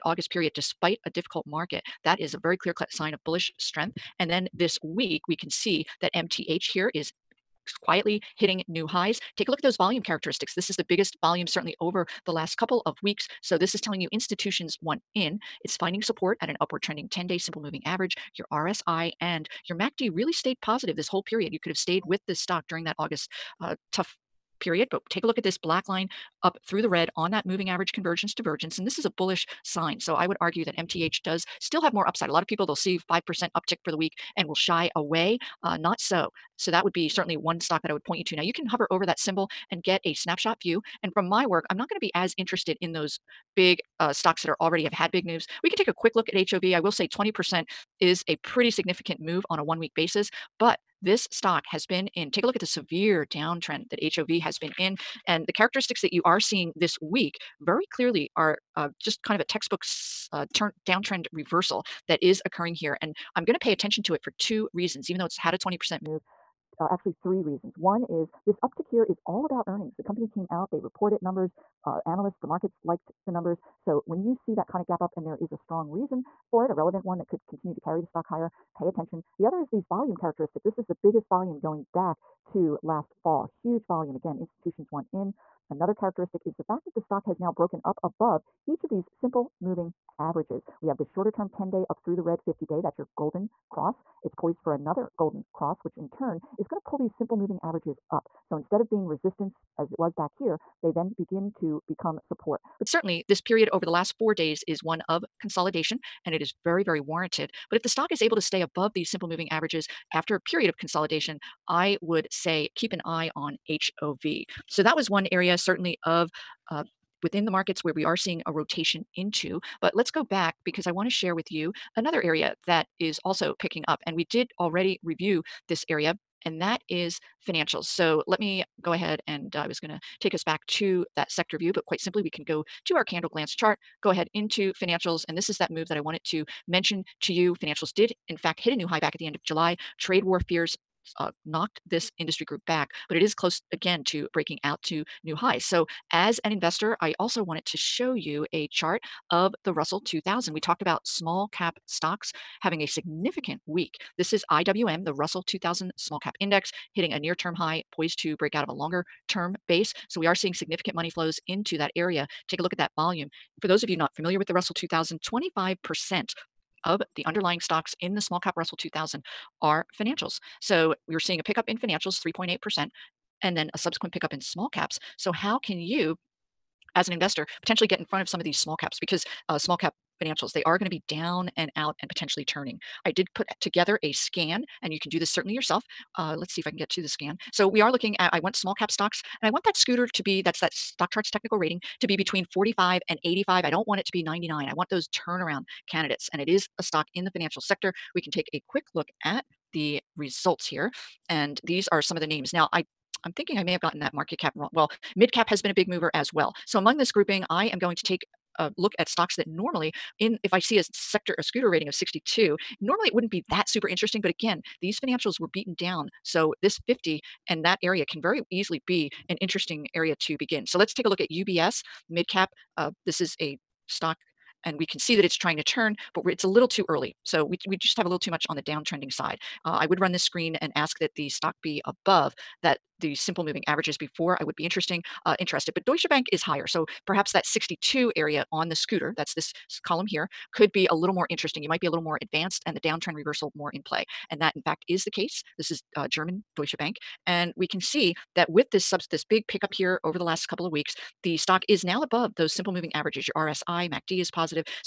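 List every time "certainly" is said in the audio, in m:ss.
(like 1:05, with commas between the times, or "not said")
0:11, 0:37, 1:42, 1:55, 3:05.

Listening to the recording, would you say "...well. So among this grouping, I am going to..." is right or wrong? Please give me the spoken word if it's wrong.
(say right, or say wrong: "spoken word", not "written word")
right.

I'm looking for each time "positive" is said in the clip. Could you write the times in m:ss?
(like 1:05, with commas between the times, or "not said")
0:20, 4:14.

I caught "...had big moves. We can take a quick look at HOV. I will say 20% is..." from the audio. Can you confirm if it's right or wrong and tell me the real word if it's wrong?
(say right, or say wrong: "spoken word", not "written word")
right.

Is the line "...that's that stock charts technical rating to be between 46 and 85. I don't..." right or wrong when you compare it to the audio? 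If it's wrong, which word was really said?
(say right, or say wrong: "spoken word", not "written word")
wrong: "45", not "46".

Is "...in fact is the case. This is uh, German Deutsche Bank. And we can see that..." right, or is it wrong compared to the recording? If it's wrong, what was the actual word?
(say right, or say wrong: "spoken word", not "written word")
right.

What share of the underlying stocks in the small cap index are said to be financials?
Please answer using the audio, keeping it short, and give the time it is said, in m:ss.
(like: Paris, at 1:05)
25%, at 2:45.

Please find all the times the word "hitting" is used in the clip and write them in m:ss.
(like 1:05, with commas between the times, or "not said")
0:08, 2:36.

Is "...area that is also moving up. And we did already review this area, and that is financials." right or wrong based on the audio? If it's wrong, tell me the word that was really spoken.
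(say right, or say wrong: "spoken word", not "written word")
wrong: "picking", not "moving".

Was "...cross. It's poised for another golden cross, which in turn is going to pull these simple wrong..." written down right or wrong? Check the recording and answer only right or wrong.
wrong.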